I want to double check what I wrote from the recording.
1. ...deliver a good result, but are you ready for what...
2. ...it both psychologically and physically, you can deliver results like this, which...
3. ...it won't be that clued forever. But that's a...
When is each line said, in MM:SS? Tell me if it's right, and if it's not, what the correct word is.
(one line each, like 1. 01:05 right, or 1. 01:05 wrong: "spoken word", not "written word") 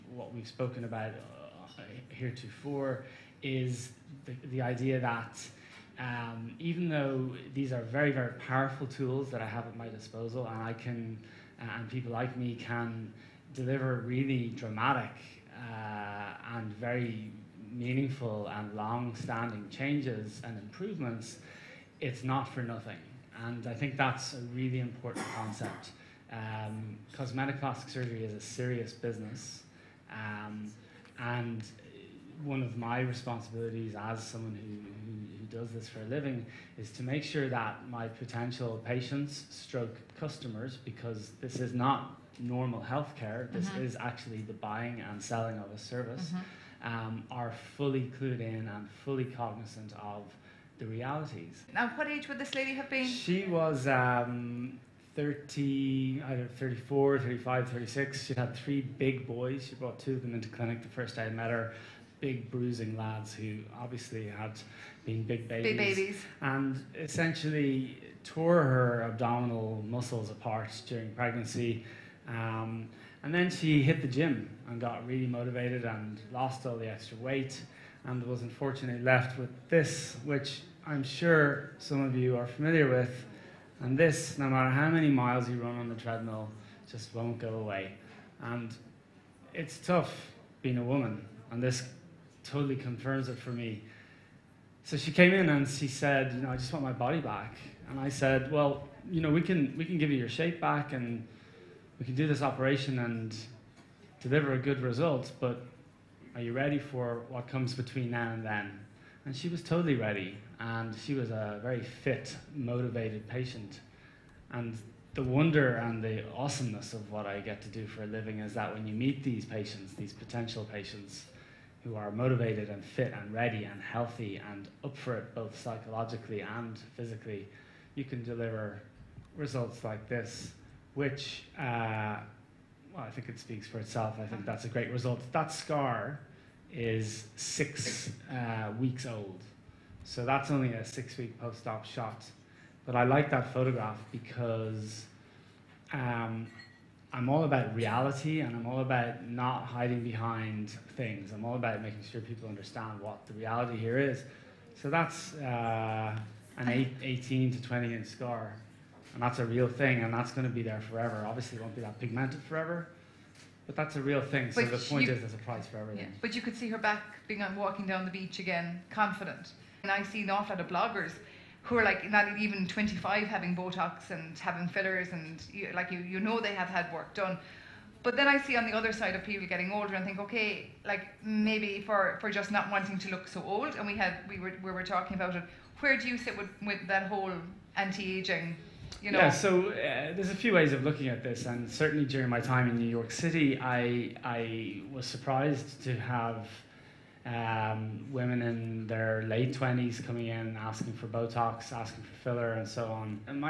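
1. 01:44 right
2. 02:05 right
3. 02:41 wrong: "pigmented", not "clued".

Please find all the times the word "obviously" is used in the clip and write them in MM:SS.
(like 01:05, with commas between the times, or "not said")
01:03, 02:41.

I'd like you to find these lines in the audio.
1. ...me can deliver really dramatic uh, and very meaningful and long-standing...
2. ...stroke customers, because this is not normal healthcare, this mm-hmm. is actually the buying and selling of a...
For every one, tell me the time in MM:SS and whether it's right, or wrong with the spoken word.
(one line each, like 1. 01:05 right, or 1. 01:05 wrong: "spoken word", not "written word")
1. 00:12 right
2. 00:39 right.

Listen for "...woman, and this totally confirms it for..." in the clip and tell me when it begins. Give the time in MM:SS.
01:30.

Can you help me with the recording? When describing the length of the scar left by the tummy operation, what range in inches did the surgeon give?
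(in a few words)
18 to 20 inches.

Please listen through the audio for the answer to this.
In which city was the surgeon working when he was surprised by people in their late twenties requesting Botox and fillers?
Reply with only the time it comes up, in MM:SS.
03:12.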